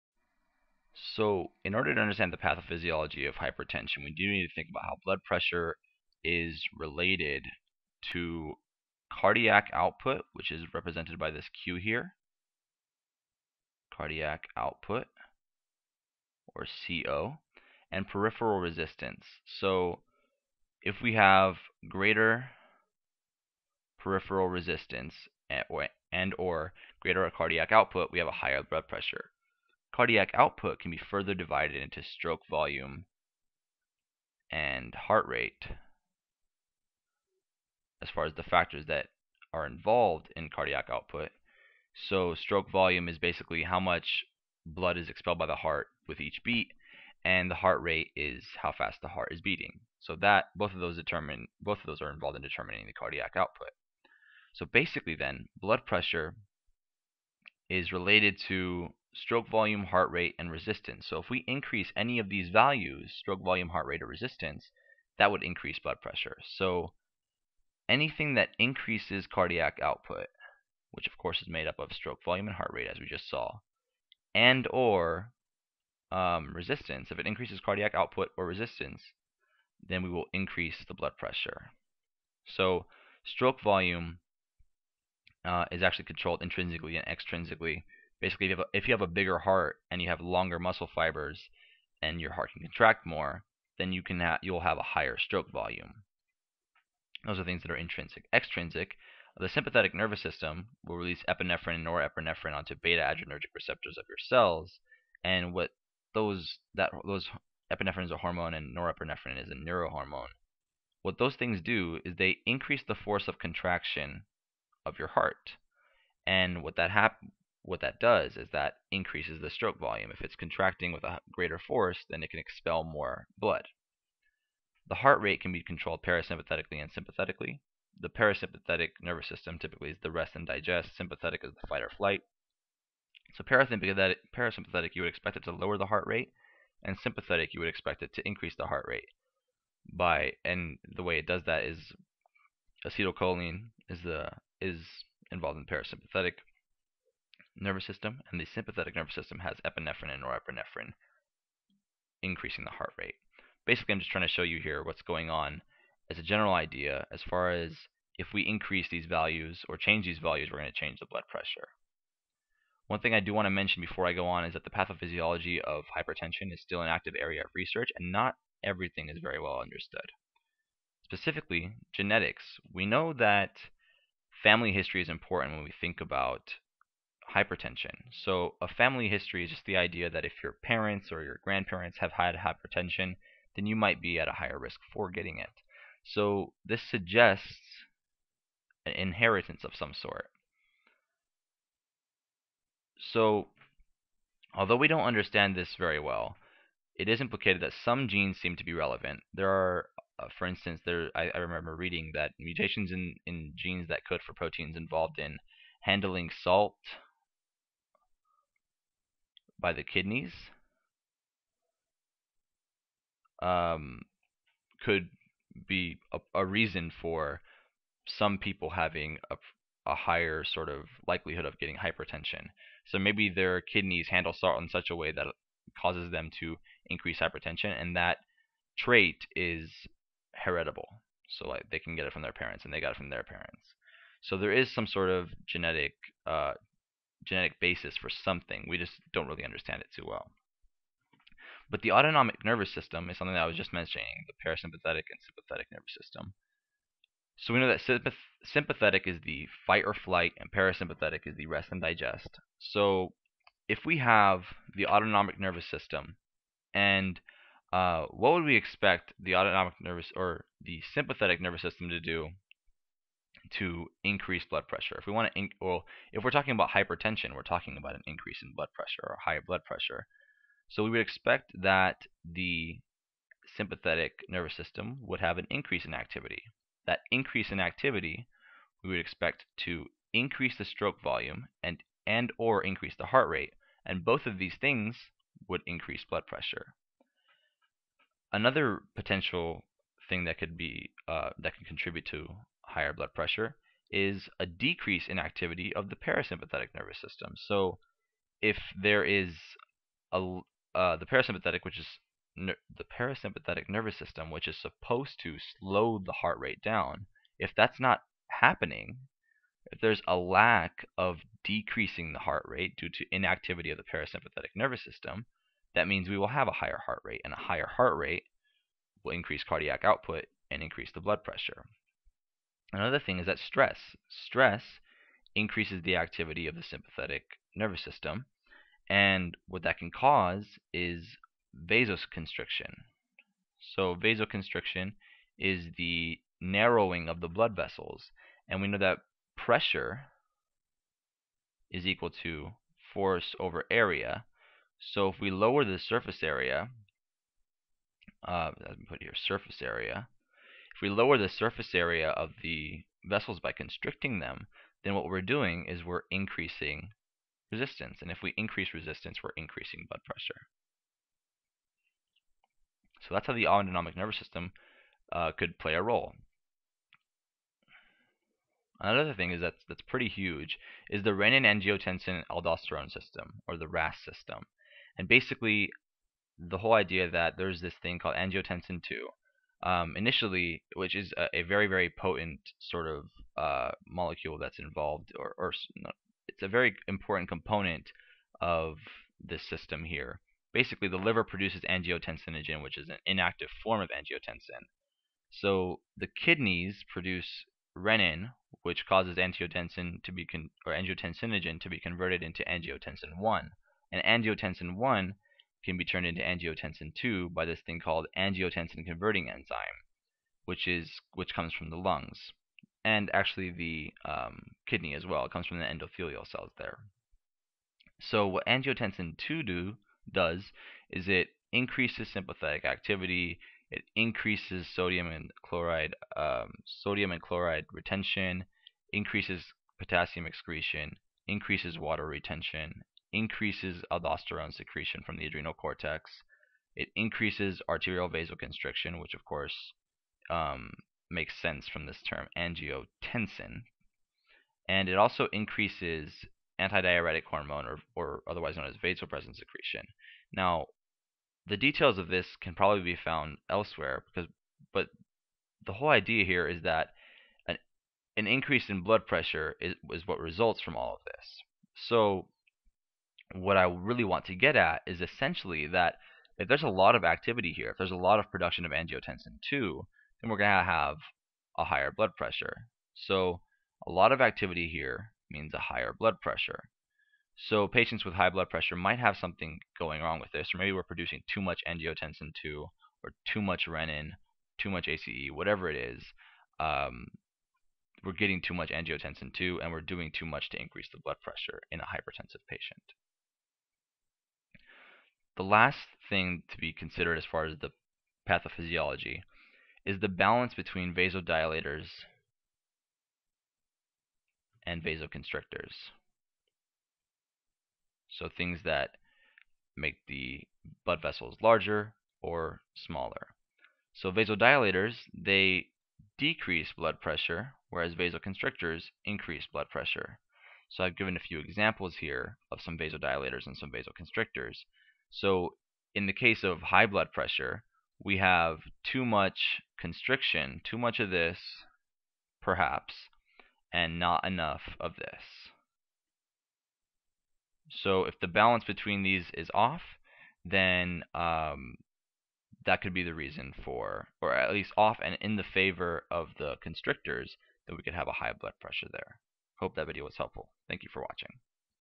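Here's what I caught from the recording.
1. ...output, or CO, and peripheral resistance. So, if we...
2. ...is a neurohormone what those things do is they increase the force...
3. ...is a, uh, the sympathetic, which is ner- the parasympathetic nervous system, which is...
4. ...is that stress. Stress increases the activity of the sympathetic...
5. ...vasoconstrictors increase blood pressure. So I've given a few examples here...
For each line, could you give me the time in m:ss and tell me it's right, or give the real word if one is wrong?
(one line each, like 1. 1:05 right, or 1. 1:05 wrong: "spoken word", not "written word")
1. 0:14 right
2. 1:49 right
3. 4:59 wrong: "parasympathetic", not "sympathetic"
4. 5:23 right
5. 8:37 right.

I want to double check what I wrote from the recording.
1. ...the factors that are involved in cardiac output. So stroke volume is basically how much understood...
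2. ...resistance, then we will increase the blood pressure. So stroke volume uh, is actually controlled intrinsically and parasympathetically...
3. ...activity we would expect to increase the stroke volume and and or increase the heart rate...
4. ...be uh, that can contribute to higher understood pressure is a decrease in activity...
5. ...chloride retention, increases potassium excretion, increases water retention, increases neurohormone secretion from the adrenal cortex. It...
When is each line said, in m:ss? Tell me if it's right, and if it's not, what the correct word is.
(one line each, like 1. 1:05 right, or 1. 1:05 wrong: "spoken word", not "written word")
1. 0:38 wrong: "blood", not "understood"
2. 1:18 wrong: "extrinsically", not "parasympathetically"
3. 4:37 right
4. 4:50 wrong: "blood", not "understood"
5. 7:07 wrong: "aldosterone", not "neurohormone".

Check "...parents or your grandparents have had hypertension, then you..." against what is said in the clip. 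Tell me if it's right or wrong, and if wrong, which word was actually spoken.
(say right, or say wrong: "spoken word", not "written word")
right.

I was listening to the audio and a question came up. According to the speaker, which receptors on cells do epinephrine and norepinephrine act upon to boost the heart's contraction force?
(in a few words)
beta adrenergic receptors.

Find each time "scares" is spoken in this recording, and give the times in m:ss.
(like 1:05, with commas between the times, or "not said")
not said.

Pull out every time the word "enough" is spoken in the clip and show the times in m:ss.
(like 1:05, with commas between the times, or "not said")
8:54.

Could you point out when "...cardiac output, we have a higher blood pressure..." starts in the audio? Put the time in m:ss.
0:27.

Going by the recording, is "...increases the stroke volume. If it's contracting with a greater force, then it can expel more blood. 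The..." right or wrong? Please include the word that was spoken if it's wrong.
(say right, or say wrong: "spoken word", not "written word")
right.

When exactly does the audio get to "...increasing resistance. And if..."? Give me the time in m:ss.
5:56.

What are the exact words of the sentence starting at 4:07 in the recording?
So we know that sympathetic is the fight or flight, and parasympathetic is the rest and digest.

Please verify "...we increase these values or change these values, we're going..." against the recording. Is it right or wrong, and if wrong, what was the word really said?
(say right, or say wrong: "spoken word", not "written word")
right.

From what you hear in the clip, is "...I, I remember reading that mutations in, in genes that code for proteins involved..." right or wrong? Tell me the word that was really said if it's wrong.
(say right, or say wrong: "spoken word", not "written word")
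right.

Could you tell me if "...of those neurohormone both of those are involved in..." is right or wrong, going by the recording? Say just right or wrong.
wrong.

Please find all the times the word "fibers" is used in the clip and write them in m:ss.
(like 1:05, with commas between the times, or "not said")
1:30.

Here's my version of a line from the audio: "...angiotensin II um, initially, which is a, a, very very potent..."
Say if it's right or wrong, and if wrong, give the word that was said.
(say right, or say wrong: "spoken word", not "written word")
right.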